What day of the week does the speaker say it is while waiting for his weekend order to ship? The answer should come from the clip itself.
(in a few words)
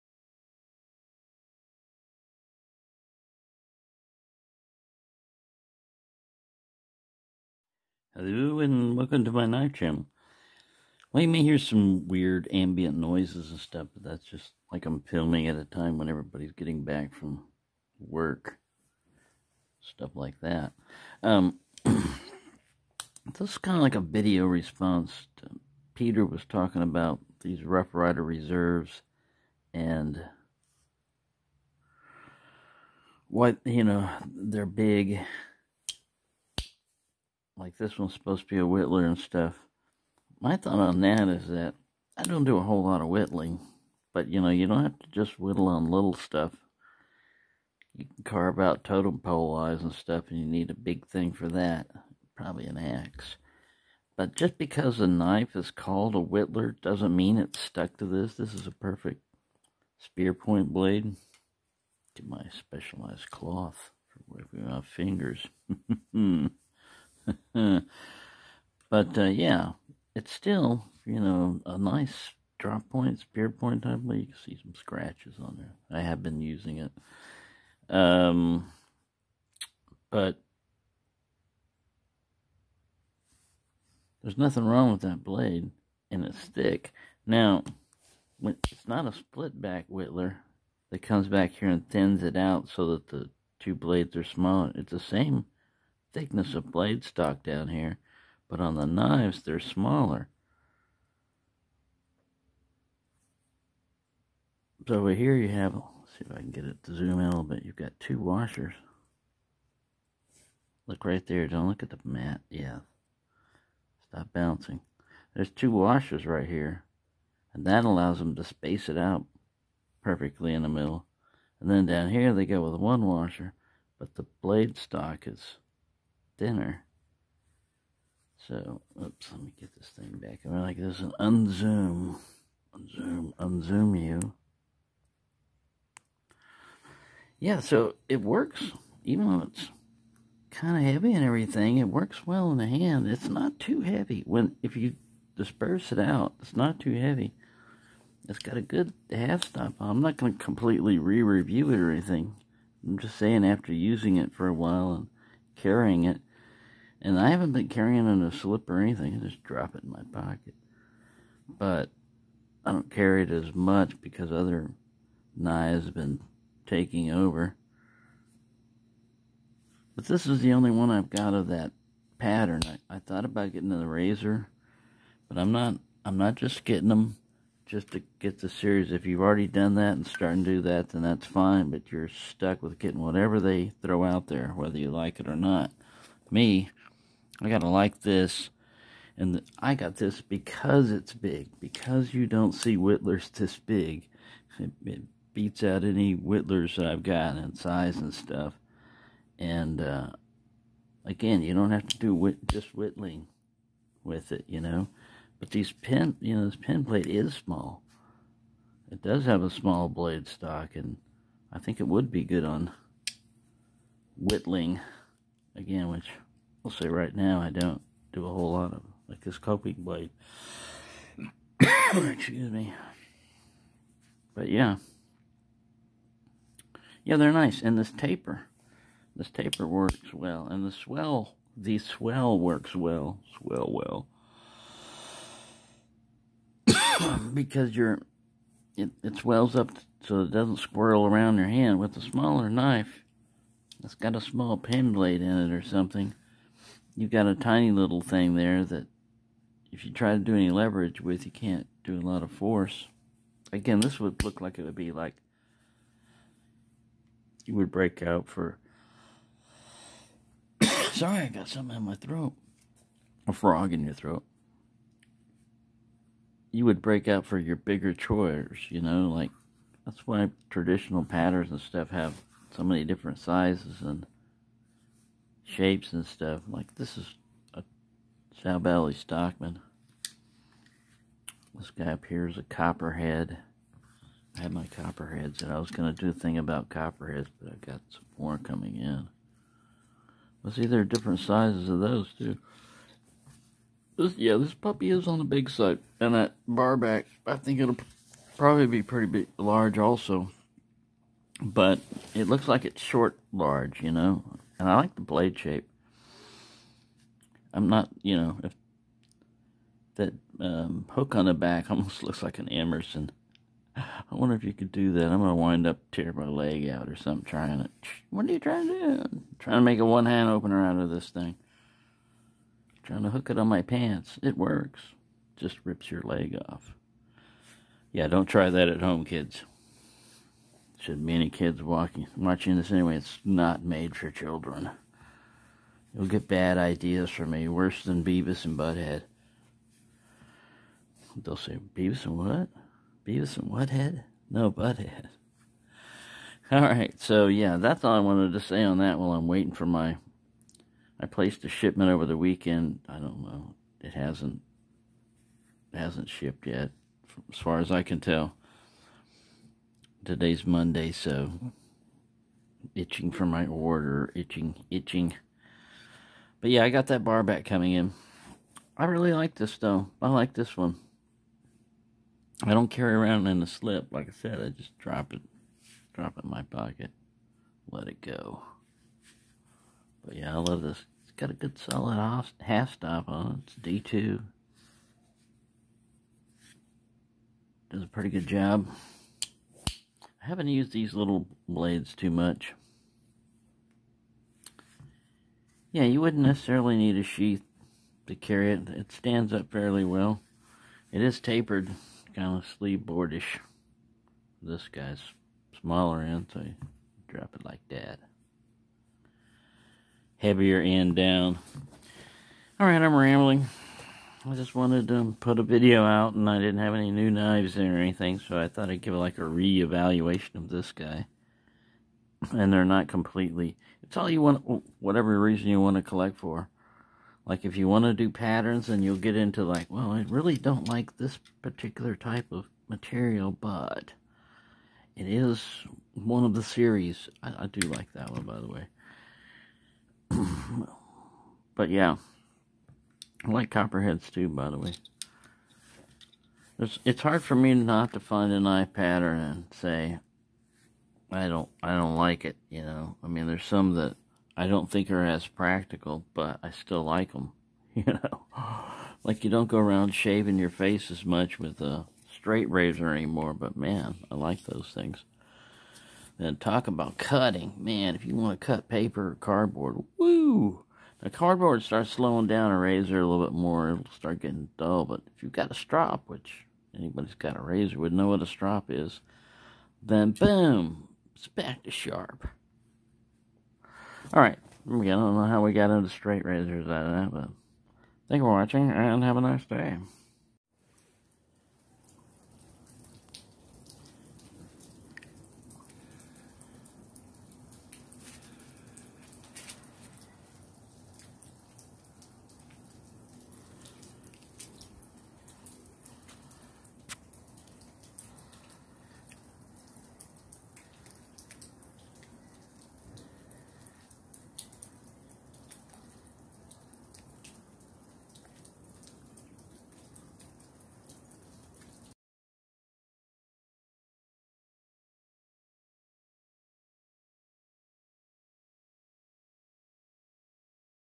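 Monday.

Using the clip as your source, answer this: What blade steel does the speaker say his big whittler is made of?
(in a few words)
D2.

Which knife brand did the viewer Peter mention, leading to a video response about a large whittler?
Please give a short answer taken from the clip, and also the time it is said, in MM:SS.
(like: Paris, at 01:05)
Rough Rider, at 00:27.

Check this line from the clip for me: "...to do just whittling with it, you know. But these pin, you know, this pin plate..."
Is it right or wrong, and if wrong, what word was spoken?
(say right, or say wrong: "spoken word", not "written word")
right.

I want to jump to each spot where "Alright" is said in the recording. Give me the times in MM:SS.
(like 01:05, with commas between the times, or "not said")
05:46, 06:52, 08:04.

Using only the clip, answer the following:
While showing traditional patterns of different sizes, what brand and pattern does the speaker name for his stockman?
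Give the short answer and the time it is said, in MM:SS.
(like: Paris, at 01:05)
Sal Valley Stockman, at 04:38.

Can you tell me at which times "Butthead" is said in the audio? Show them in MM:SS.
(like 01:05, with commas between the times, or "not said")
05:38, 05:44.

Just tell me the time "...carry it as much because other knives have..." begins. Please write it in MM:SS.
02:42.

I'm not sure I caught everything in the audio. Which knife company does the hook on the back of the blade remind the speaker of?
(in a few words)
Emerson.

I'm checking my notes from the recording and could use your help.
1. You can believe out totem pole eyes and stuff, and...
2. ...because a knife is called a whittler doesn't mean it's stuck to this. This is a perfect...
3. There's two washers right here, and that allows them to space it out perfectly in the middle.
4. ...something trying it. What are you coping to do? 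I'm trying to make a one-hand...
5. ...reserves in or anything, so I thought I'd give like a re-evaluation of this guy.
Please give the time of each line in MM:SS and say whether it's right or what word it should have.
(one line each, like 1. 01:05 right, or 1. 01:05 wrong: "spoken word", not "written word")
1. 00:47 wrong: "carve", not "believe"
2. 00:54 right
3. 01:55 right
4. 05:16 wrong: "trying", not "coping"
5. 06:57 wrong: "knives", not "reserves".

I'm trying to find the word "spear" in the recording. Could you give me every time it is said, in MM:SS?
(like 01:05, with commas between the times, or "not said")
00:59, 01:13.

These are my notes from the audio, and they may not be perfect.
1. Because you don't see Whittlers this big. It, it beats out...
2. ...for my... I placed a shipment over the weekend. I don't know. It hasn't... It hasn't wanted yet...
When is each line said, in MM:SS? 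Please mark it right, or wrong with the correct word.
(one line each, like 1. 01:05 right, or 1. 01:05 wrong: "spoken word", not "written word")
1. 03:11 right
2. 05:49 wrong: "shipped", not "wanted".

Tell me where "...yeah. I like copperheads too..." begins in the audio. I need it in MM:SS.
07:21.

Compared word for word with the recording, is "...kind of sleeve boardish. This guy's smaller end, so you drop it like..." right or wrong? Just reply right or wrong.
right.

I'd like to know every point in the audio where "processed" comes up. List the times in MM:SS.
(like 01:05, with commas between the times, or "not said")
not said.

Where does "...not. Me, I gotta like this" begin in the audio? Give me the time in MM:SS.
03:05.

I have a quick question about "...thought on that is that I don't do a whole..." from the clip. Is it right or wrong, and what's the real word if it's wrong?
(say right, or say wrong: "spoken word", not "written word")
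right.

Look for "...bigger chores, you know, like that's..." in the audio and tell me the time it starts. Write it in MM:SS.
04:27.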